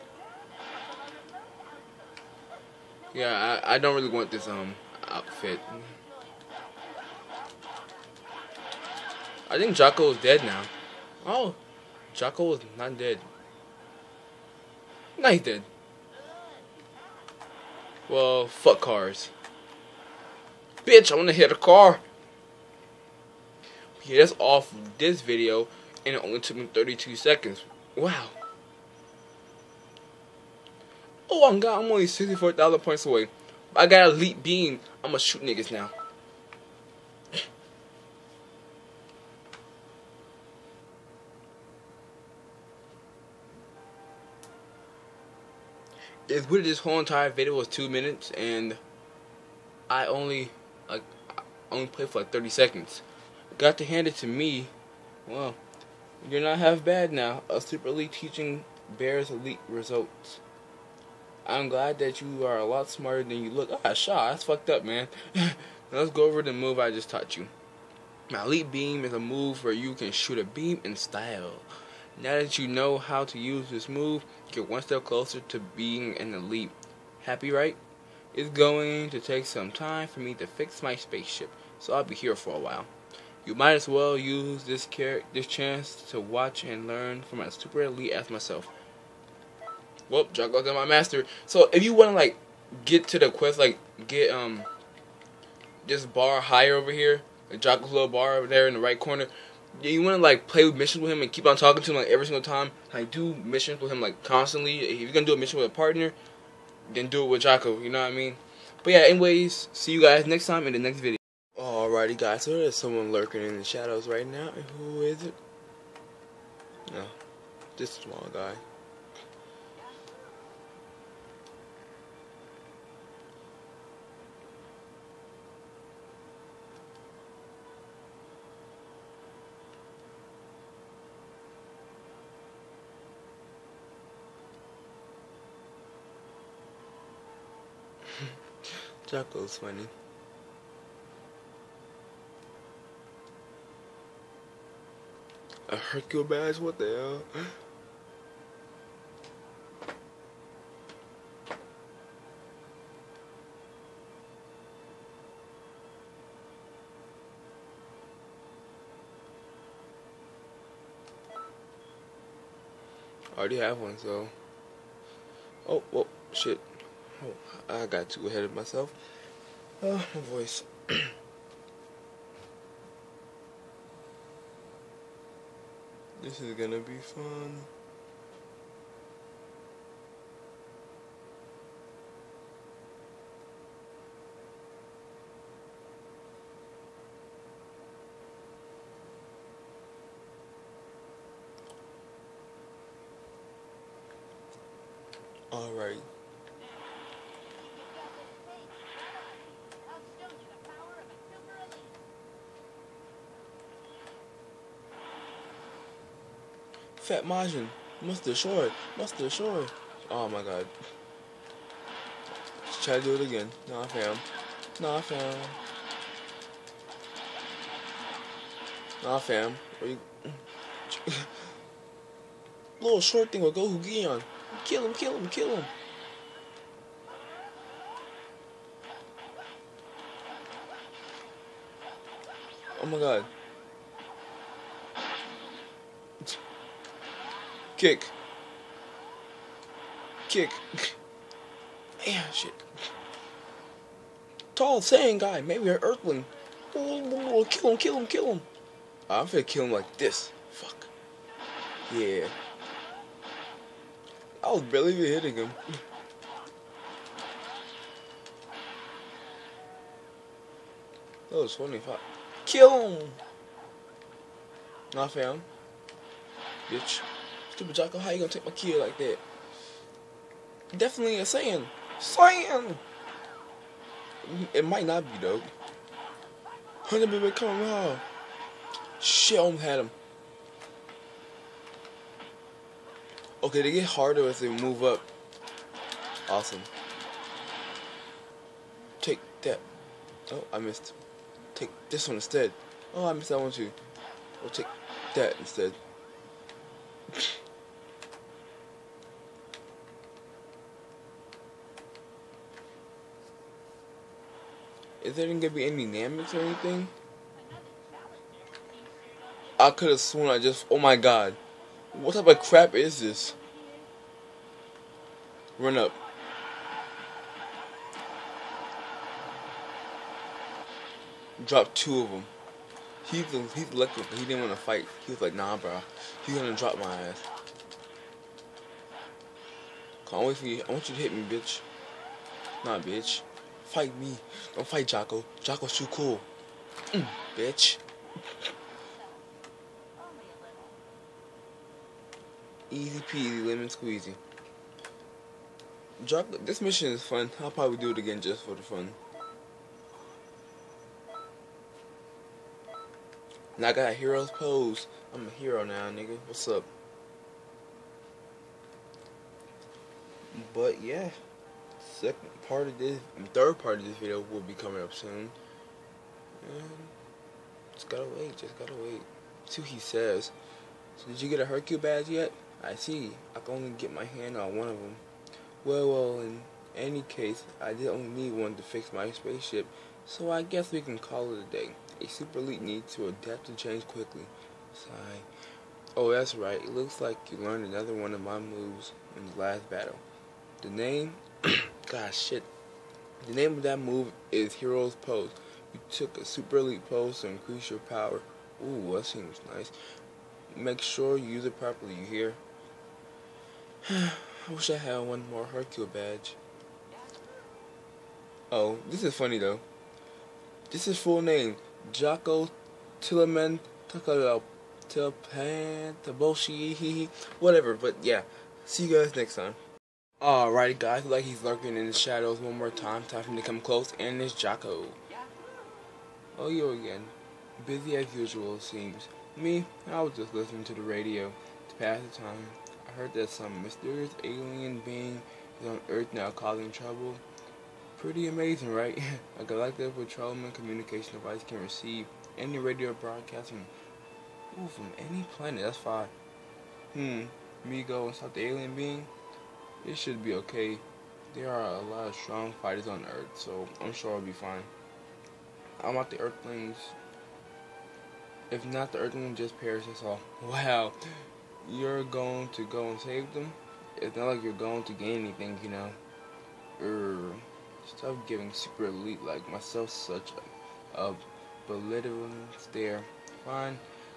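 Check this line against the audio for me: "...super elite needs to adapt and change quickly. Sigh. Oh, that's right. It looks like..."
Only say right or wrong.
right.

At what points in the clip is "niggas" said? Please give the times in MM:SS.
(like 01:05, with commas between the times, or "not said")
00:35, 05:55.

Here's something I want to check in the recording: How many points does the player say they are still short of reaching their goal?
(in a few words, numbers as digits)
64,000.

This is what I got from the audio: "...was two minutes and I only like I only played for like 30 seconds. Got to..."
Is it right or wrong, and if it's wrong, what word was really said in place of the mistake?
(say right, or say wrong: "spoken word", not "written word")
right.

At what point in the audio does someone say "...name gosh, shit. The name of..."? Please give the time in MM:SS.
06:30.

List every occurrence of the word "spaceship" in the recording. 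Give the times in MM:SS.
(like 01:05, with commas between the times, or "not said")
01:20, 06:19.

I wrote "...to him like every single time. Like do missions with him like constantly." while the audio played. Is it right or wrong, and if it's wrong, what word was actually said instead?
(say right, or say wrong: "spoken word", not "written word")
right.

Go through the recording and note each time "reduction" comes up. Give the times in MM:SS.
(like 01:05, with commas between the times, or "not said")
not said.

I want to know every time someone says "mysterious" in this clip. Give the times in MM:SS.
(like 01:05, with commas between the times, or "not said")
07:13.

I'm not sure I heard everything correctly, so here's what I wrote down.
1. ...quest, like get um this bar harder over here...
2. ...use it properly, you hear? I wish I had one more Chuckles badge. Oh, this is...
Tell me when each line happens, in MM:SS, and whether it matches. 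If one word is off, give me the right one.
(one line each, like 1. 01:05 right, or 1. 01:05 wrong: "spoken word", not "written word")
1. 01:33 wrong: "higher", not "harder"
2. 06:41 wrong: "Hercule", not "Chuckles".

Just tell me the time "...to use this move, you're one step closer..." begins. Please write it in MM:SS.
01:13.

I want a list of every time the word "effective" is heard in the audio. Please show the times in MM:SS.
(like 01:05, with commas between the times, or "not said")
not said.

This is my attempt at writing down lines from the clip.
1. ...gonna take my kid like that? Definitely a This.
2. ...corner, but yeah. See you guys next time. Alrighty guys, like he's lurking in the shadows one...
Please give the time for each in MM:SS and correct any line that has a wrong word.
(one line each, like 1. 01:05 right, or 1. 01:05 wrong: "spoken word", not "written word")
1. 04:28 wrong: "Saiyan", not "This"
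2. 06:57 wrong: "whatever", not "corner".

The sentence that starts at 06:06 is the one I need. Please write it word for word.
And just gotta wait, just gotta wait.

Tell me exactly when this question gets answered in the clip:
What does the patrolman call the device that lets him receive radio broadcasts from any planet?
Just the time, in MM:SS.
07:19.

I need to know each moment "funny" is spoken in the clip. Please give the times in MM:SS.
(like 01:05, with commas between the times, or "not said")
02:19, 04:21, 06:49.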